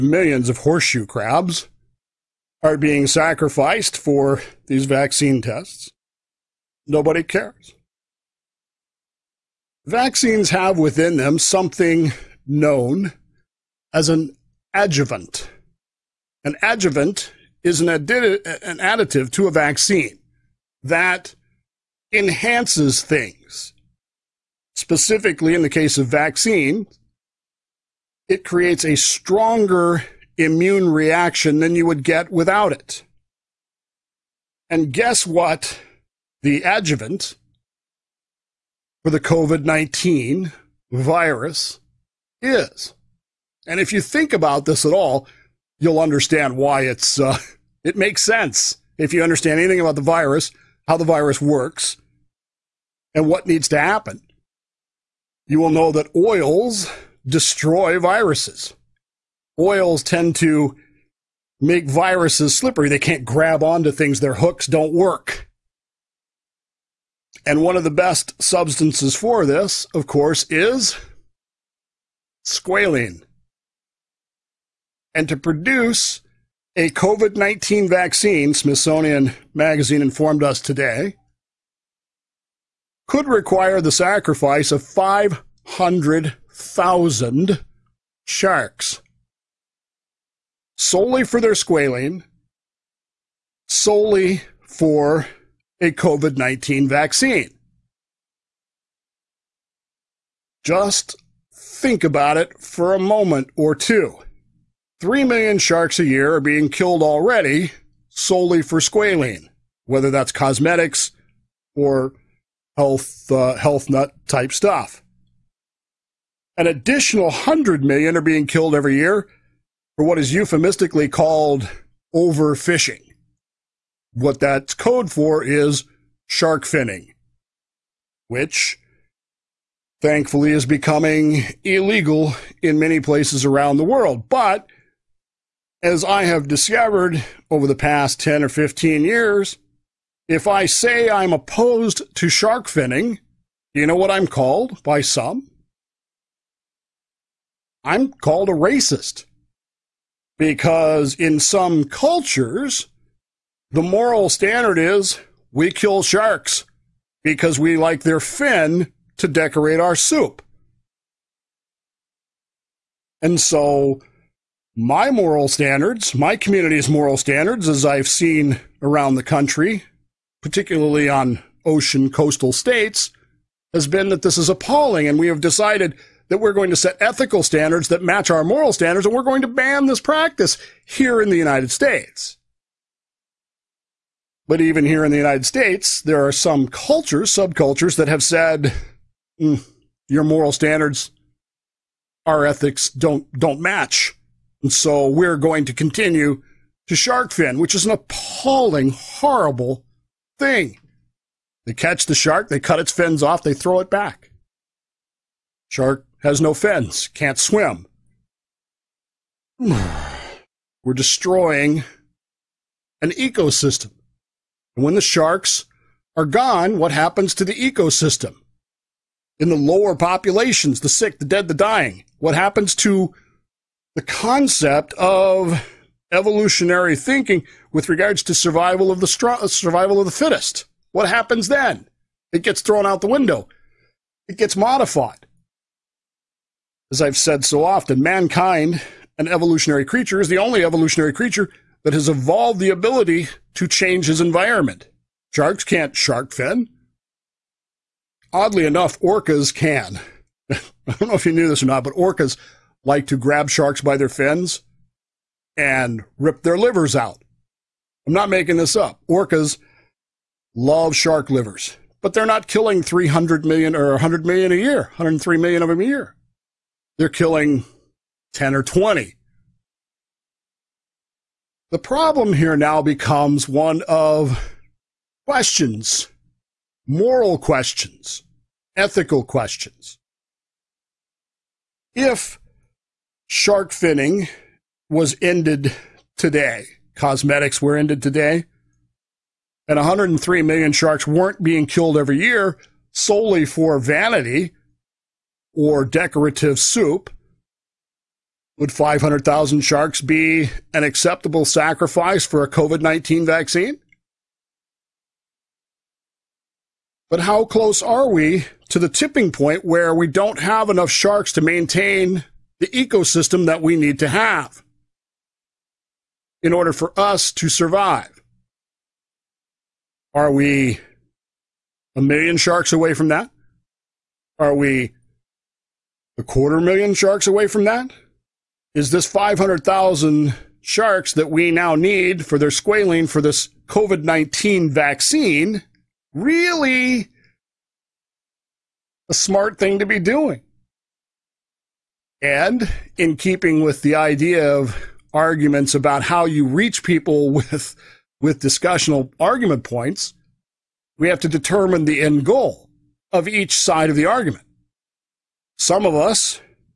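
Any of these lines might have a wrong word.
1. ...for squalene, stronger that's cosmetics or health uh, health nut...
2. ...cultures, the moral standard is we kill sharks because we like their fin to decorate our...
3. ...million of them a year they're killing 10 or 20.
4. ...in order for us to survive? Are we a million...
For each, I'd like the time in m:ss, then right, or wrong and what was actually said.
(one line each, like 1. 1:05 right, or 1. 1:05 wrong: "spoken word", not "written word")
1. 1:48 wrong: "whether", not "stronger"
2. 2:31 right
3. 4:25 right
4. 5:16 right.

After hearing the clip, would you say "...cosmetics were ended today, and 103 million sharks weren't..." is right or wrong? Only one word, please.
right.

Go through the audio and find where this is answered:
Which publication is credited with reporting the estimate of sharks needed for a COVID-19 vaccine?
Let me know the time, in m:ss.
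1:18.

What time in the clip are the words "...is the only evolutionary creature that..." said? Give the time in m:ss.
4:00.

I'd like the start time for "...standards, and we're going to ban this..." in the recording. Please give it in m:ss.
2:58.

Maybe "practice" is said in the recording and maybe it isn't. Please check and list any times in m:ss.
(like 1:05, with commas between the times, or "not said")
2:59.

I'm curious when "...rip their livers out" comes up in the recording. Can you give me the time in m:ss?
4:16.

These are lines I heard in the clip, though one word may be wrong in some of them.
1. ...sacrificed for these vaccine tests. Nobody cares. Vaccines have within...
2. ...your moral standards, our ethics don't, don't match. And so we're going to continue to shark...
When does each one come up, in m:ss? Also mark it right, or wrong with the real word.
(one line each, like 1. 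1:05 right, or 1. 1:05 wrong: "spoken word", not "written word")
1. 0:03 right
2. 3:10 right.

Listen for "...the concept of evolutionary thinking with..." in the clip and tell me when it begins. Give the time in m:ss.
3:43.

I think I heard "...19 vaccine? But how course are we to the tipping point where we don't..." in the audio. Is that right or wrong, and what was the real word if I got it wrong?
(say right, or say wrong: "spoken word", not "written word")
wrong: "close", not "course".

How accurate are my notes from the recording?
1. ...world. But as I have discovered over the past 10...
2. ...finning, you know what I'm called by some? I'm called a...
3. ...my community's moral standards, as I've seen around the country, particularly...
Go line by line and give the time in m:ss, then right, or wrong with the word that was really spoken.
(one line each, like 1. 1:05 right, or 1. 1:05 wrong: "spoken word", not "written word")
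1. 2:13 right
2. 2:22 right
3. 2:46 right.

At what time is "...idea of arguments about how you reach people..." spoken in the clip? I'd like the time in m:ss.
5:43.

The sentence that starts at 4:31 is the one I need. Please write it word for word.
The problem here now becomes one of questions, moral questions, ethical questions.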